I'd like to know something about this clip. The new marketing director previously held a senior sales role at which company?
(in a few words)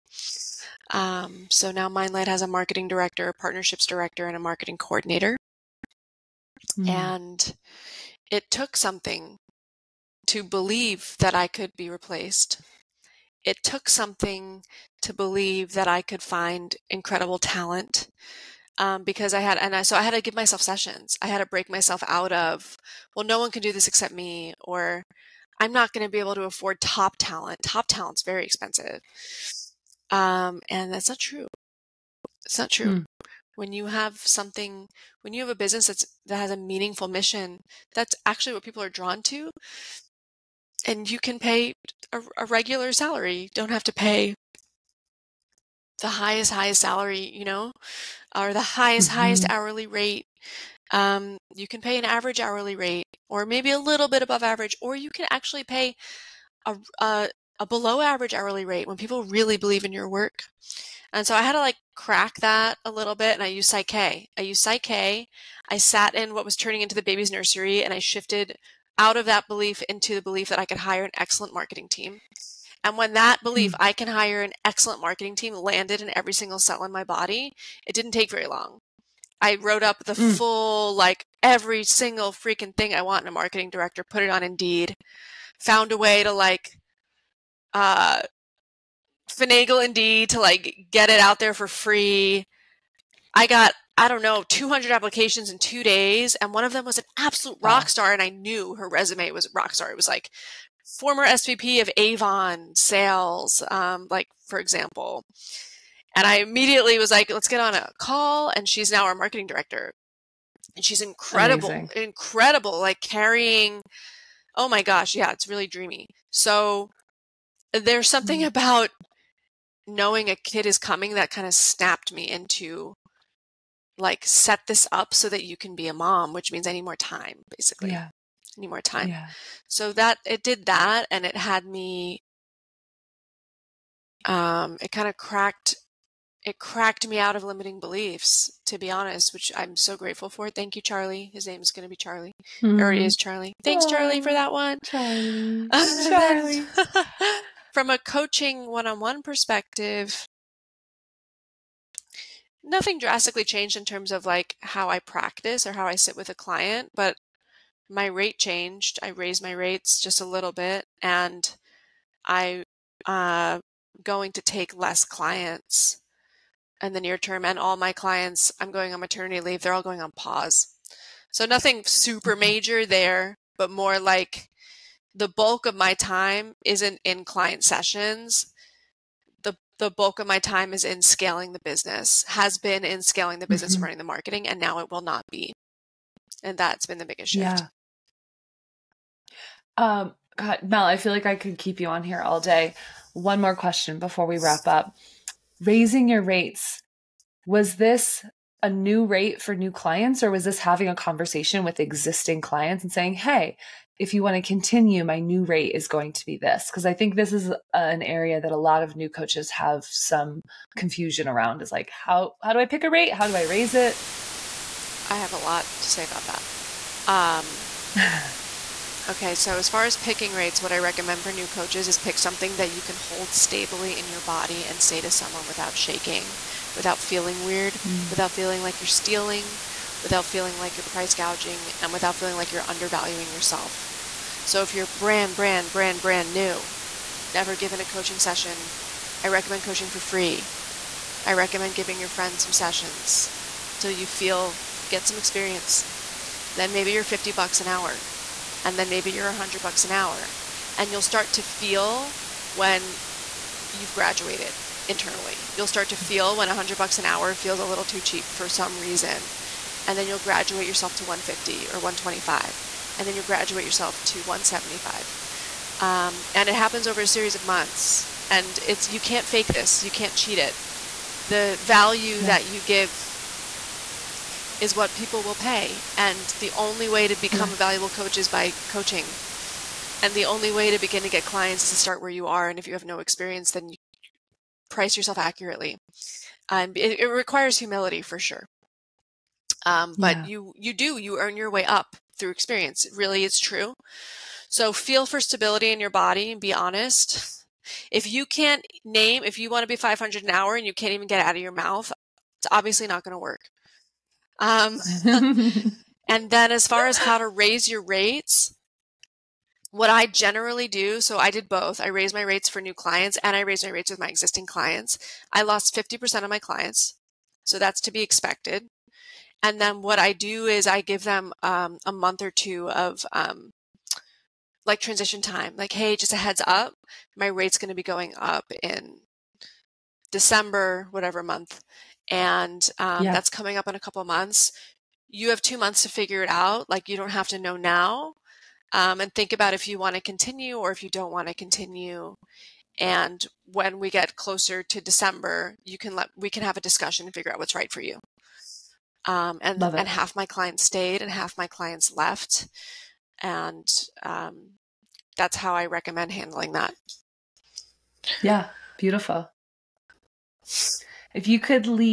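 Avon.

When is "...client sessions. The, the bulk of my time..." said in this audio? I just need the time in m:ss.
2:57.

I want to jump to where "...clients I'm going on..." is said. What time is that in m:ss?
2:47.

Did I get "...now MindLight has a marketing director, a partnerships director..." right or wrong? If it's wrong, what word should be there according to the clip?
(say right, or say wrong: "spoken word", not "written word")
right.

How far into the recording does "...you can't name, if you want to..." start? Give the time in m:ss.
4:58.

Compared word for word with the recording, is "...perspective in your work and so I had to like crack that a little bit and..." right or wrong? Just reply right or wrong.
wrong.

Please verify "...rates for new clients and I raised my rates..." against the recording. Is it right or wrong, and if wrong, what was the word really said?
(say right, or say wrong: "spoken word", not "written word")
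right.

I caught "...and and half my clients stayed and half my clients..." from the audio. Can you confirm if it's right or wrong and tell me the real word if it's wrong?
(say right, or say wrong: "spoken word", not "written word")
right.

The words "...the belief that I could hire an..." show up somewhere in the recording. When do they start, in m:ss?
1:10.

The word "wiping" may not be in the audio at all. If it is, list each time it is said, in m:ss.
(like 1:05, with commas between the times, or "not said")
not said.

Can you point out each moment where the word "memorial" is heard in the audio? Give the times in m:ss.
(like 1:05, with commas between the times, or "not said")
not said.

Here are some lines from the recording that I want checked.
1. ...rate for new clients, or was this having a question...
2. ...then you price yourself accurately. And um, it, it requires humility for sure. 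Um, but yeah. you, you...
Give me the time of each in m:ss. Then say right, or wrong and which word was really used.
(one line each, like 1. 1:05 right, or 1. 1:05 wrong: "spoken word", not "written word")
1. 3:19 wrong: "conversation", not "question"
2. 4:43 right.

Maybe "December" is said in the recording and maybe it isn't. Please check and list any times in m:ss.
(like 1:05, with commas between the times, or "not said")
5:30, 5:44.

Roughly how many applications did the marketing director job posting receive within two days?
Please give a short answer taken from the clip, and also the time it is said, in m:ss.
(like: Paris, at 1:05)
200, at 1:34.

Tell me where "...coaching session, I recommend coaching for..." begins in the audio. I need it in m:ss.
3:57.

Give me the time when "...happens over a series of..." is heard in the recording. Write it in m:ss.
4:26.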